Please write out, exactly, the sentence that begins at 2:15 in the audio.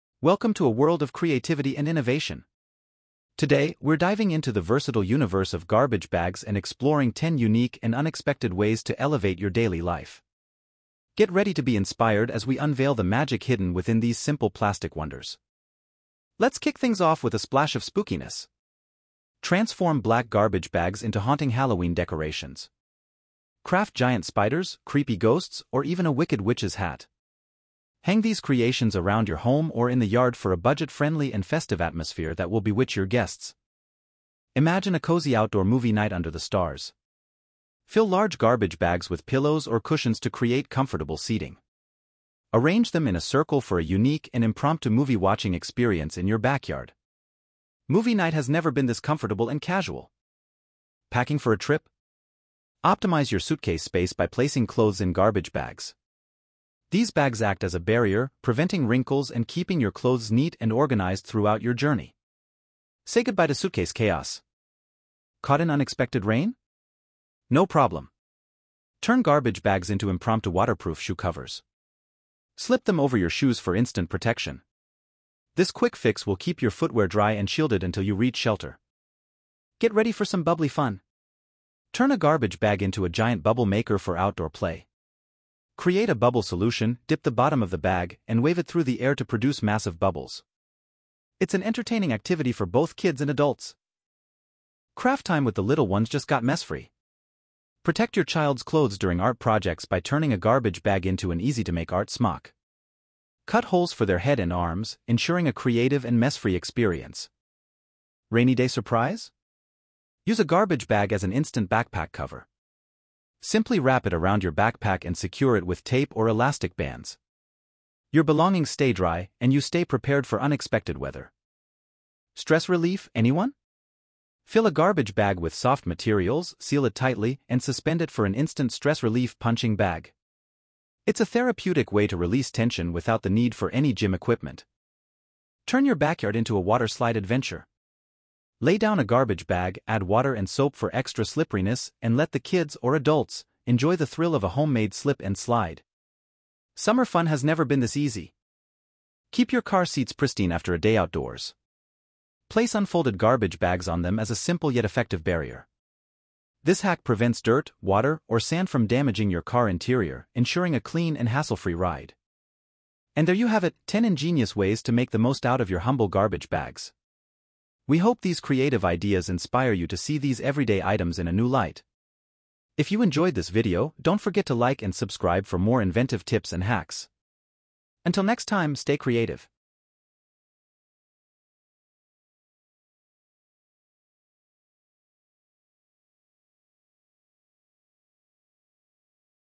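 Turn your backyard into a water slide adventure.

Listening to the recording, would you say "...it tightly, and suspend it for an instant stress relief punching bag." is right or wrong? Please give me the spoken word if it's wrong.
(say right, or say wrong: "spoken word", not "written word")
right.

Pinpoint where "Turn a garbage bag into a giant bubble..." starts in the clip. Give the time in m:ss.
1:21.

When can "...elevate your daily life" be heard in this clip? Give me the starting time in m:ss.
0:09.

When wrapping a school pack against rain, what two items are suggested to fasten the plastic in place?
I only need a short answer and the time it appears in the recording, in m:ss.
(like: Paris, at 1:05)
Tape or elastic bands, at 1:55.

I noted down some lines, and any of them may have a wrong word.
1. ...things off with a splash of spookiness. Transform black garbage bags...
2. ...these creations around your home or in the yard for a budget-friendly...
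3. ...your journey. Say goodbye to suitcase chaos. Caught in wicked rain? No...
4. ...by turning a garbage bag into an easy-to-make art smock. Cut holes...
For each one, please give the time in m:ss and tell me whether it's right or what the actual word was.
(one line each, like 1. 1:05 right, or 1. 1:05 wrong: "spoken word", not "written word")
1. 0:16 right
2. 0:28 right
3. 1:01 wrong: "unexpected", not "wicked"
4. 1:39 right.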